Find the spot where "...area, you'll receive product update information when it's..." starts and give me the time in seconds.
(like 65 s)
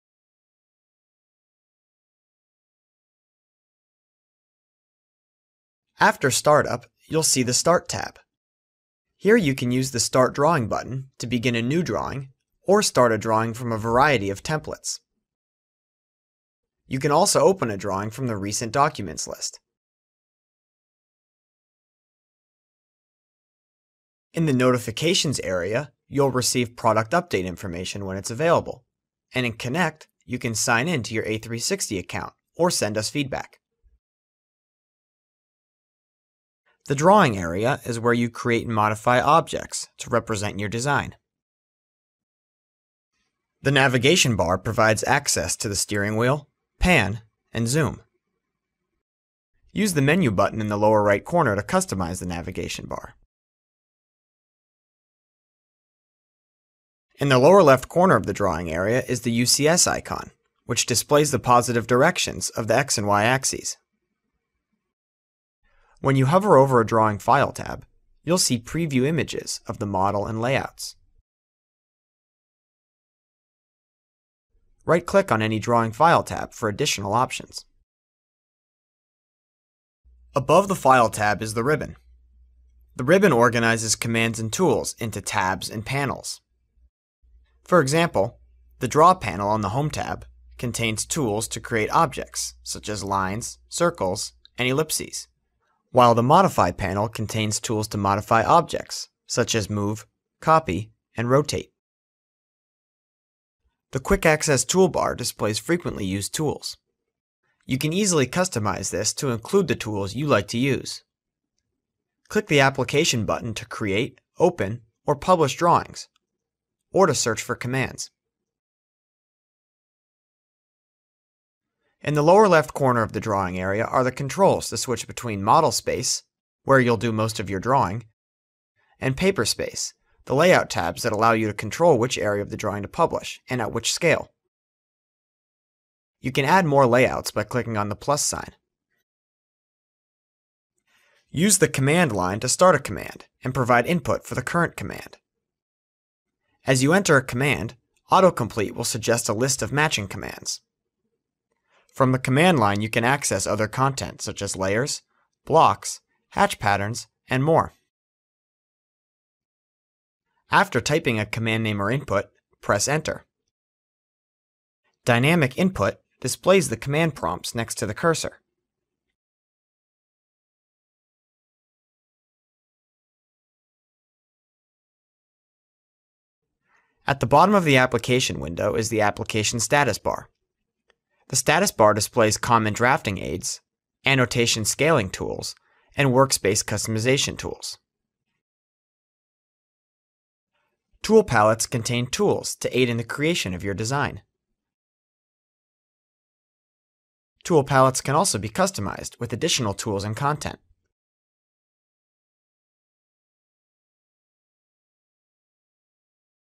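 25 s.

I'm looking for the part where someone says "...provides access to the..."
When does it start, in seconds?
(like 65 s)
44 s.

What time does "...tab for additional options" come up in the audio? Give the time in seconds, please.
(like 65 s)
76 s.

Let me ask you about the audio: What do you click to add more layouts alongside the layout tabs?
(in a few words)
The plus sign.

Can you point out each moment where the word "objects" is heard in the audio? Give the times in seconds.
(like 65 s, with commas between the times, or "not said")
39 s, 91 s, 98 s.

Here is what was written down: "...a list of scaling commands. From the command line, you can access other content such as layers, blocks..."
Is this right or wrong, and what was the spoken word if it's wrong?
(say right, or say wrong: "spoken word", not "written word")
wrong: "matching", not "scaling".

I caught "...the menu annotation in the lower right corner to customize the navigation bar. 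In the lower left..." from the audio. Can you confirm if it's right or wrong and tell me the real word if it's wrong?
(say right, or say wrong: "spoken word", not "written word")
wrong: "button", not "annotation".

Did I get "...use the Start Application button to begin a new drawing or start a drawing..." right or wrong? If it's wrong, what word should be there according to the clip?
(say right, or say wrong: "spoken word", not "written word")
wrong: "Drawing", not "Application".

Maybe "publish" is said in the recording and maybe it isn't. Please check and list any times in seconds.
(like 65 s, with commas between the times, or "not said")
115 s, 132 s.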